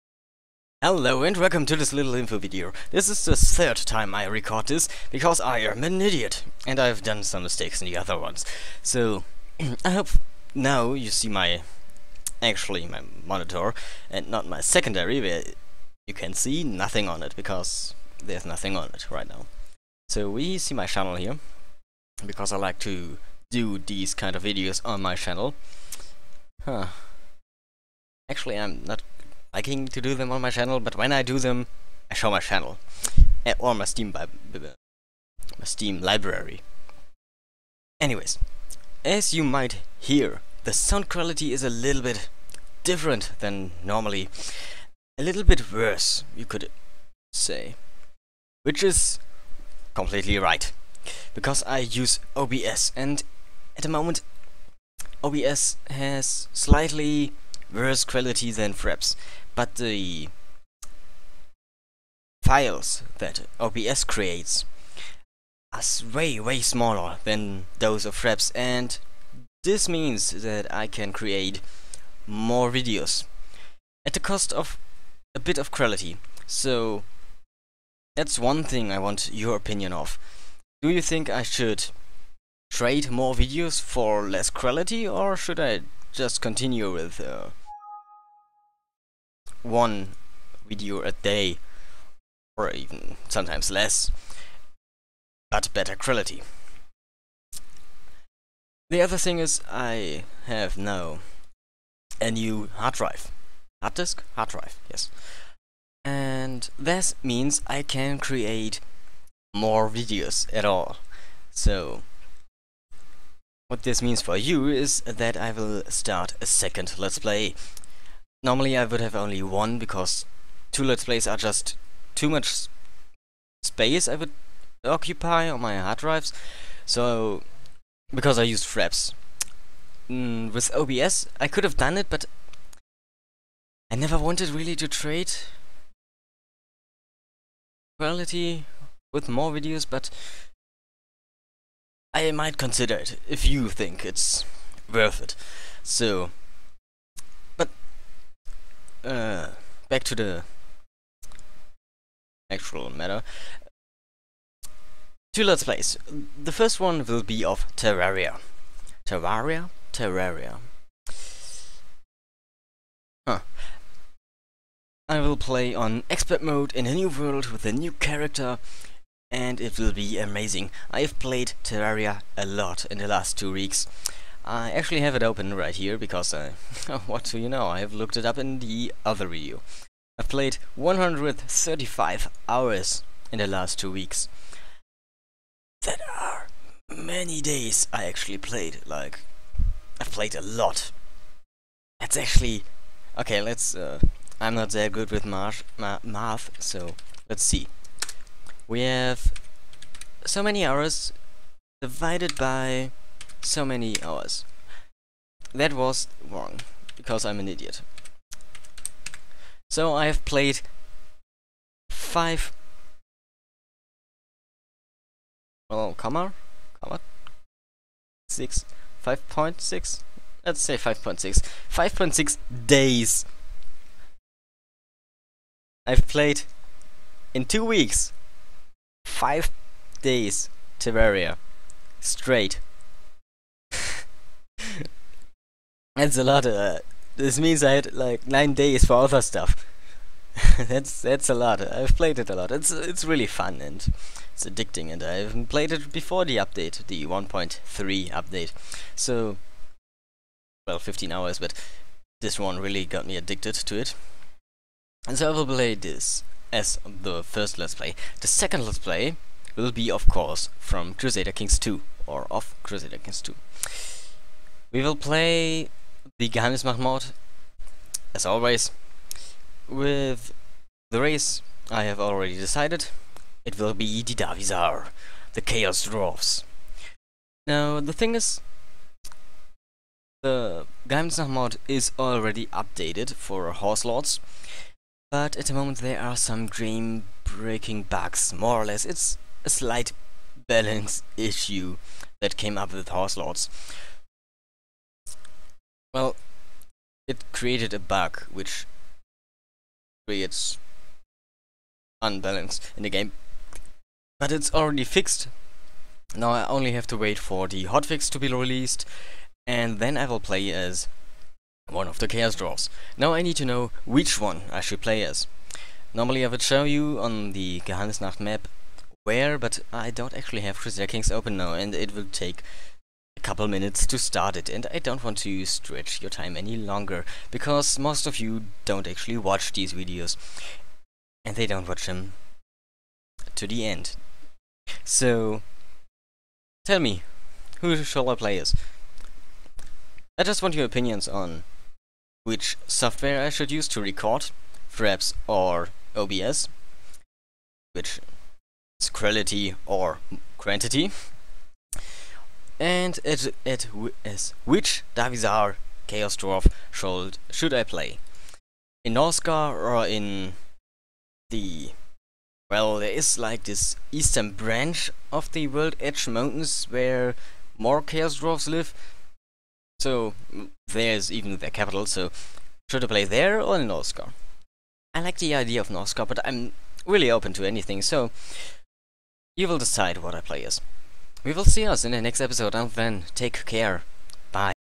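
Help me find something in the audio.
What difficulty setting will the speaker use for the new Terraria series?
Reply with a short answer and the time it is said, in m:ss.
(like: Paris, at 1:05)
Expert mode, at 2:46.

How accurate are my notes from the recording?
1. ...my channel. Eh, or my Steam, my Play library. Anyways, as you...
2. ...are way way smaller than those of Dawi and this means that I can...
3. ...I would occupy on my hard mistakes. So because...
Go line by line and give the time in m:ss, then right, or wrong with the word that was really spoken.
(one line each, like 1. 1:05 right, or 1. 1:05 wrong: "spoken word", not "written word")
1. 0:32 wrong: "Steam", not "Play"
2. 1:05 wrong: "Fraps", not "Dawi"
3. 2:04 wrong: "drives", not "mistakes".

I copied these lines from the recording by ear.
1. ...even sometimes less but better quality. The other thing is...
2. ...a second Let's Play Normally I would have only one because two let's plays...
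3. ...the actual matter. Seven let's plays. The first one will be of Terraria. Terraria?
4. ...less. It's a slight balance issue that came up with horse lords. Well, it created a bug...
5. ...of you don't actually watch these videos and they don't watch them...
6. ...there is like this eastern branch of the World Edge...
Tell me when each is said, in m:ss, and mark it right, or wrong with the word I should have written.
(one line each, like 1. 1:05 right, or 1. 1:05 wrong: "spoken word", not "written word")
1. 1:32 right
2. 1:56 right
3. 2:30 wrong: "Two", not "Seven"
4. 4:48 right
5. 5:28 right
6. 6:02 right.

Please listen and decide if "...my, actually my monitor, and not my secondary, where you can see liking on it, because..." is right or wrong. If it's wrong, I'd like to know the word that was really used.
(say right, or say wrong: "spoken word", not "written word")
wrong: "nothing", not "liking".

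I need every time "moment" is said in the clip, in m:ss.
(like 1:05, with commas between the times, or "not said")
0:53, 4:45.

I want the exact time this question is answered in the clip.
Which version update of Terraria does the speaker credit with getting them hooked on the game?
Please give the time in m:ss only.
4:07.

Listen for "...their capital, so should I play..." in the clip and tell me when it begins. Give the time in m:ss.
6:11.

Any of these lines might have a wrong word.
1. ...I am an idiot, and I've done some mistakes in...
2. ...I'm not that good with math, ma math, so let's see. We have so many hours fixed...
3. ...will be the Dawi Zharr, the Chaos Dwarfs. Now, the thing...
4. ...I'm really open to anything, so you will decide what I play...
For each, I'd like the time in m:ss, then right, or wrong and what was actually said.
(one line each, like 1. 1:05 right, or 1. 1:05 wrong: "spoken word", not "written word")
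1. 0:05 right
2. 3:14 wrong: "divided", not "fixed"
3. 4:33 right
4. 6:16 right.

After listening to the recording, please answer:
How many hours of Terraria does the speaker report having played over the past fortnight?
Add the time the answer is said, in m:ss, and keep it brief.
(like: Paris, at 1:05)
135, at 3:00.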